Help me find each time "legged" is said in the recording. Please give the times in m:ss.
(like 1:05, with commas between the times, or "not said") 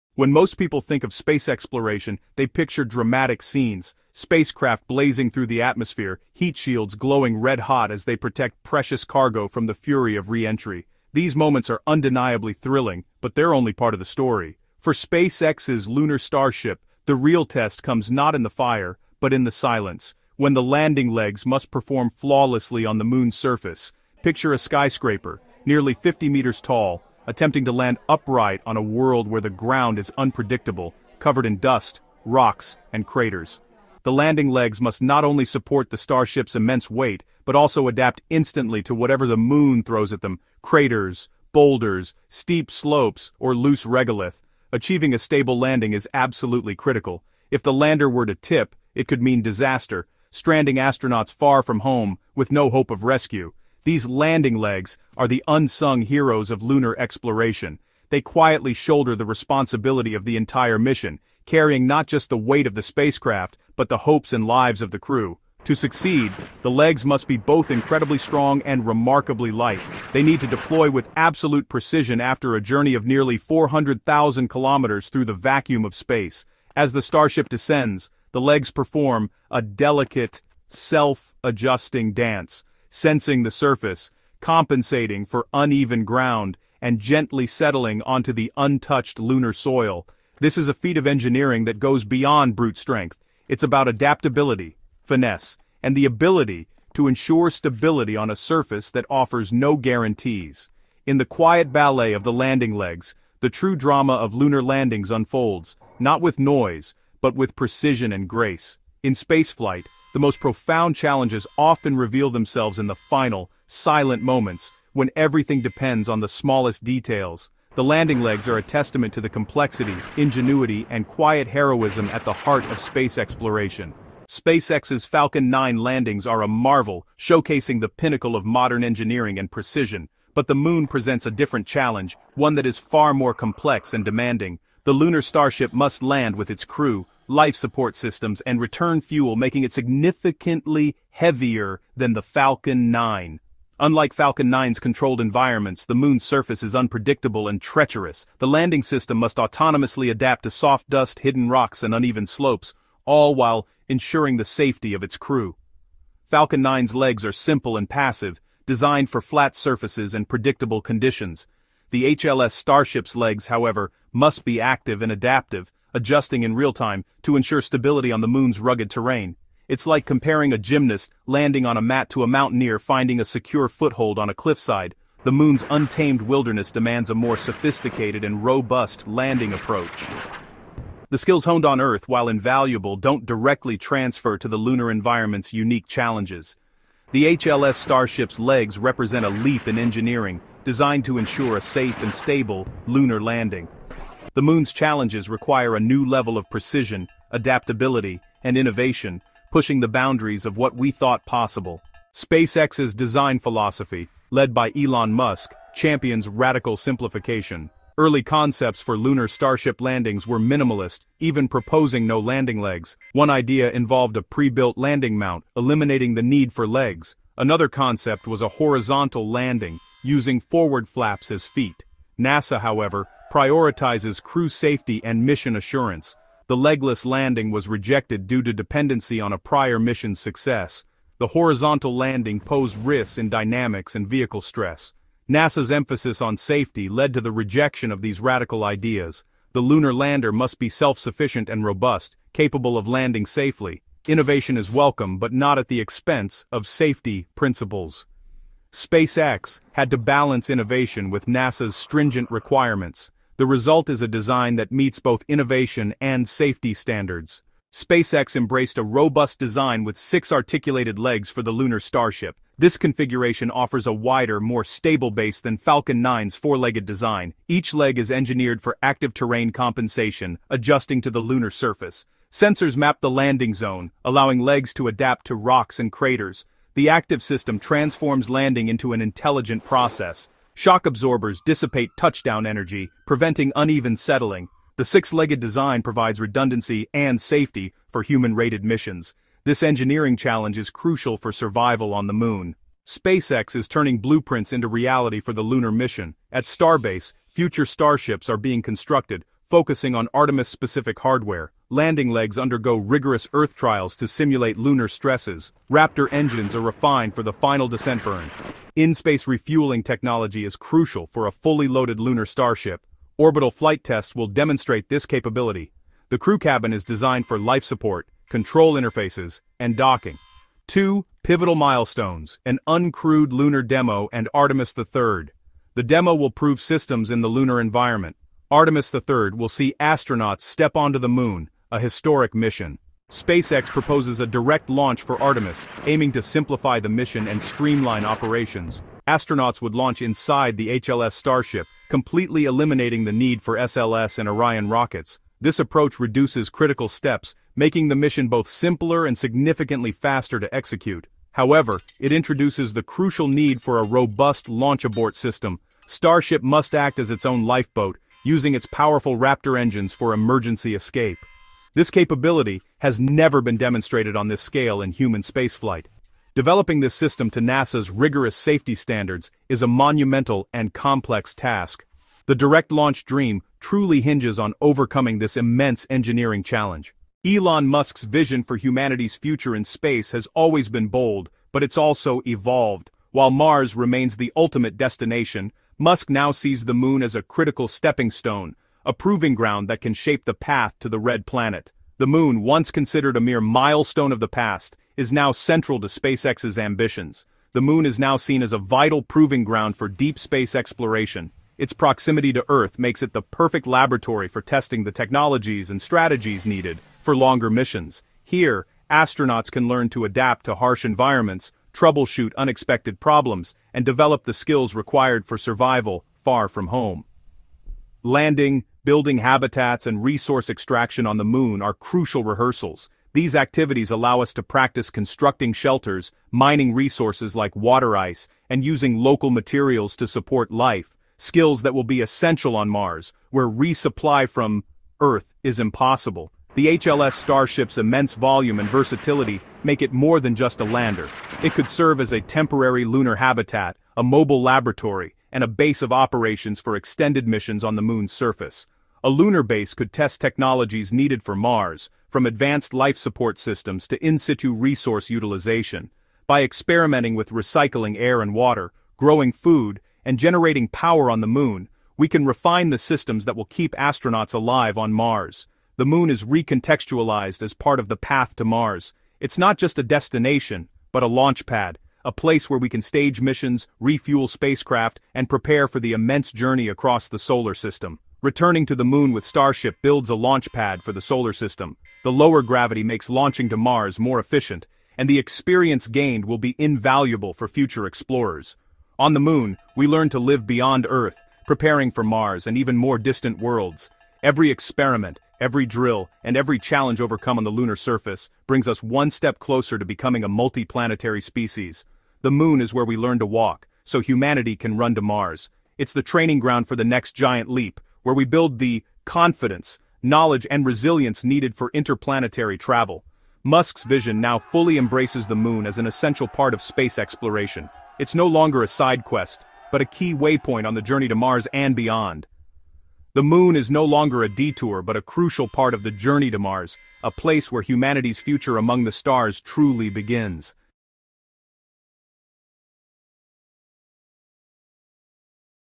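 4:26, 4:44.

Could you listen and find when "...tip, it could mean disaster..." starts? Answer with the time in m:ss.
0:48.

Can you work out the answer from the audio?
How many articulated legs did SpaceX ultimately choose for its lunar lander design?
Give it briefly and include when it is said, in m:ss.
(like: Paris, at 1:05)
6, at 4:19.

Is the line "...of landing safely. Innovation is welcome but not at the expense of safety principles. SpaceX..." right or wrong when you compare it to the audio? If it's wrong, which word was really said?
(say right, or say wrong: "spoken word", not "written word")
right.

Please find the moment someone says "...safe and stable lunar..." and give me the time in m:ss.
3:11.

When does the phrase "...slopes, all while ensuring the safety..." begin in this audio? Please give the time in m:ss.
2:32.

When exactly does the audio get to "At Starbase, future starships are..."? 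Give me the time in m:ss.
4:56.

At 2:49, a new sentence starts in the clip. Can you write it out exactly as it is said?
It's like comparing a gymnast landing on a mat to a mountaineer finding a secure foothold on a cliffside.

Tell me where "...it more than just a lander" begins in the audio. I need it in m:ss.
7:19.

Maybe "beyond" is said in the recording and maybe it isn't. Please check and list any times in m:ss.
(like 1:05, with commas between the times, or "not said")
1:32, 8:10, 8:41.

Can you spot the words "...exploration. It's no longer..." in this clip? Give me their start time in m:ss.
8:36.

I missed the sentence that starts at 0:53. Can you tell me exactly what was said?
These landing legs are the unsung heroes of lunar exploration.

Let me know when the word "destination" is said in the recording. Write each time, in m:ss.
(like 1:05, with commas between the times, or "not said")
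6:24, 7:49.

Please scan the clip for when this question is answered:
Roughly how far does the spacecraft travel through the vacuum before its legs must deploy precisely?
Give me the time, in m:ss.
1:13.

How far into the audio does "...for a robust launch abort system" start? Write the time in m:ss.
5:53.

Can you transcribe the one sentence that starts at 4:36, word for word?
The active system transforms landing into an intelligent process.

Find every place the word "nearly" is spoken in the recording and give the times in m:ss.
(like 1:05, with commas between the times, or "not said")
0:25, 1:13.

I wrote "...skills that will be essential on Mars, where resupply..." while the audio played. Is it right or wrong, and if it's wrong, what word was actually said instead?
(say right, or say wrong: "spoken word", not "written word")
right.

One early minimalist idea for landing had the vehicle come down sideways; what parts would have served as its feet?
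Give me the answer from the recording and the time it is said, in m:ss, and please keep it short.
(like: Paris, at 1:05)
Forward flaps, at 3:40.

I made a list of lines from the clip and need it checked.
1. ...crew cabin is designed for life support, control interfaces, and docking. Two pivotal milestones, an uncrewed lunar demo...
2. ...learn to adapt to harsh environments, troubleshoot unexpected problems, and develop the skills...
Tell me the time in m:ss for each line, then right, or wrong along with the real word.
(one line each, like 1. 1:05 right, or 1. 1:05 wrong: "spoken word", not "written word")
1. 5:16 right
2. 6:49 right.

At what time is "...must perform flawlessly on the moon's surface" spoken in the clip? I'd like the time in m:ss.
0:21.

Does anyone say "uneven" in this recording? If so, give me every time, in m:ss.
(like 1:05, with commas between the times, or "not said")
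1:25, 2:31, 4:43.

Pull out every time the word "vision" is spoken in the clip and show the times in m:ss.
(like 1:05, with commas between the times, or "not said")
6:18, 8:33.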